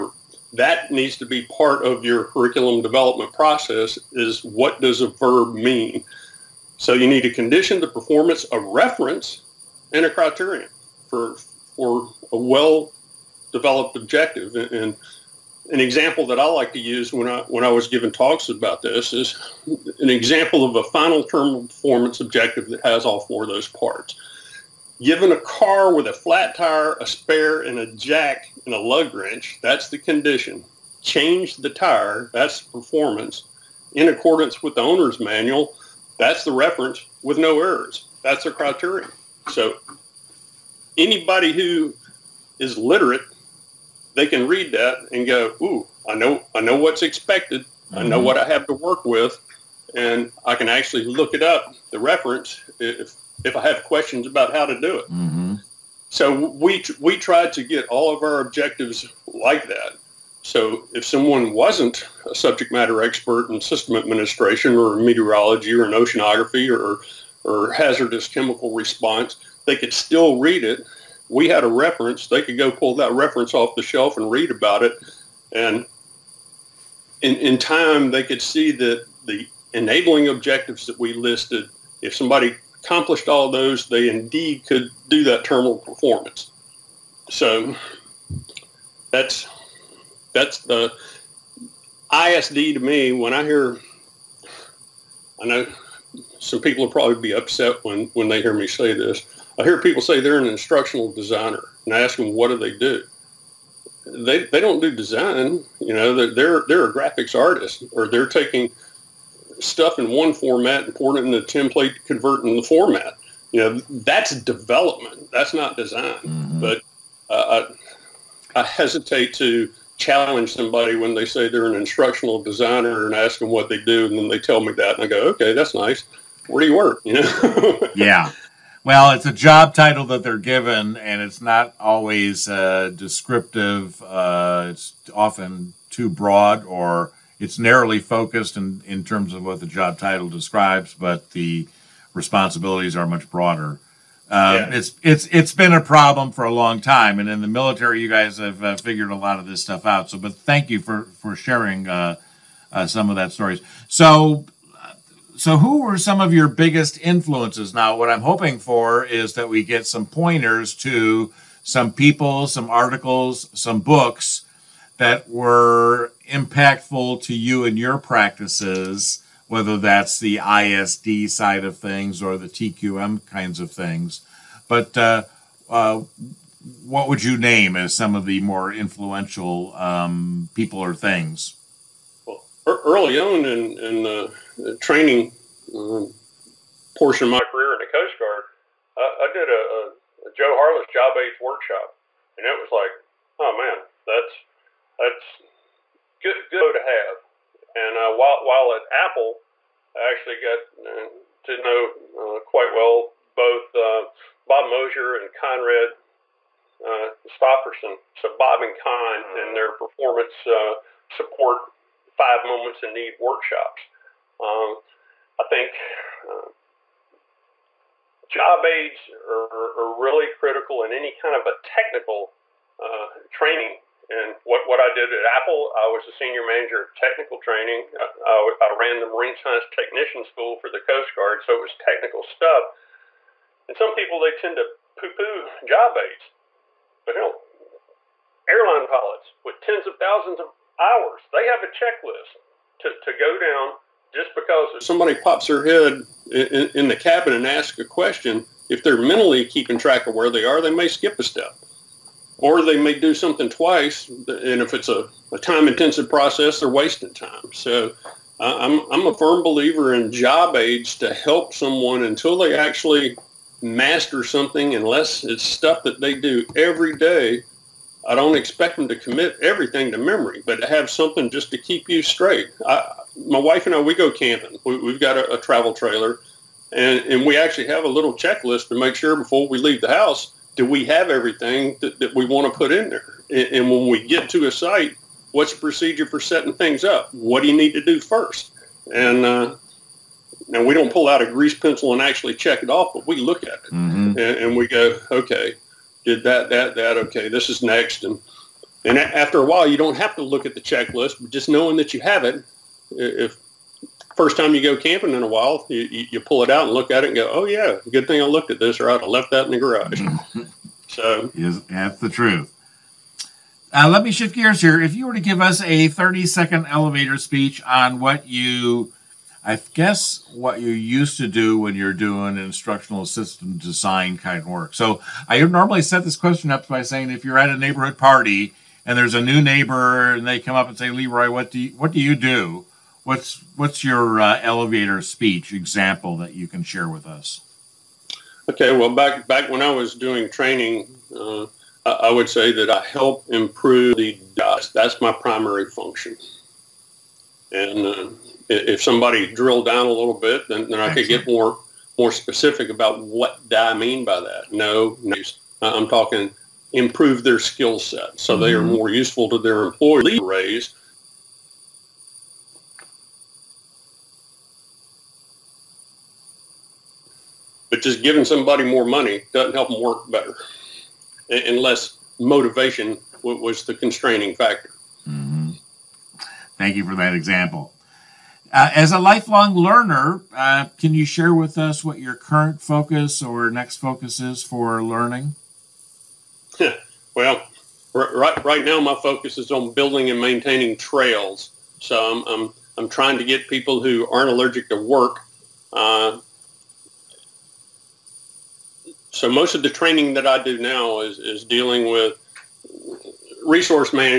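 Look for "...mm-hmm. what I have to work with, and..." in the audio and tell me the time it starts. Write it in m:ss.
0:48.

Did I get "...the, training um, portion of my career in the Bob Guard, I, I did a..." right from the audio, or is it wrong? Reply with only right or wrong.
wrong.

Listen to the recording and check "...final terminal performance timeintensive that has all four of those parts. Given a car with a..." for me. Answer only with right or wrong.
wrong.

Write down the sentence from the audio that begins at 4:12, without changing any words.
Or they may do something twice, and if it's a, a time-intensive process, they're wasting time.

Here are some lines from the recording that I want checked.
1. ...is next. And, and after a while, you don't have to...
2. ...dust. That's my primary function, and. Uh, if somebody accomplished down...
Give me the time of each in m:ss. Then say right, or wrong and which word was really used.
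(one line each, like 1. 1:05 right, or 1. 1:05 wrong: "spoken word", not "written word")
1. 4:57 right
2. 5:44 wrong: "drilled", not "accomplished".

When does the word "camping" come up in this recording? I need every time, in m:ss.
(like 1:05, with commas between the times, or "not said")
4:34, 5:04.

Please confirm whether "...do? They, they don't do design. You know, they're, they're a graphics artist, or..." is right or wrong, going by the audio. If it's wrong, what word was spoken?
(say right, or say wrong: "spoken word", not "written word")
right.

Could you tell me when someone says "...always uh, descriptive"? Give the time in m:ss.
2:11.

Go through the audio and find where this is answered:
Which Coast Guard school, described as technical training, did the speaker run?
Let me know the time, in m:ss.
3:49.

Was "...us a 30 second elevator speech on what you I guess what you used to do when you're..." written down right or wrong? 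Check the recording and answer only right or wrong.
right.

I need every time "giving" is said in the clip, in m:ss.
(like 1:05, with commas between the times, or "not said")
0:17, 6:08.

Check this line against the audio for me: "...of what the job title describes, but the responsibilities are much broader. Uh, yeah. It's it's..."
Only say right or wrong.
right.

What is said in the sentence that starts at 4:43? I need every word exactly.
And, and when we get to a site, what's the procedure for setting things up?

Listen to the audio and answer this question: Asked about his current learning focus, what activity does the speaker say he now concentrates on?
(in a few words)
Building and maintaining trails.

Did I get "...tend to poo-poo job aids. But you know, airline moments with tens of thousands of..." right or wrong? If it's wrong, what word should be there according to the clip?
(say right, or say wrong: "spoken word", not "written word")
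wrong: "pilots", not "moments".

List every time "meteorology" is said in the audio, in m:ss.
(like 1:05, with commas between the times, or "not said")
1:04.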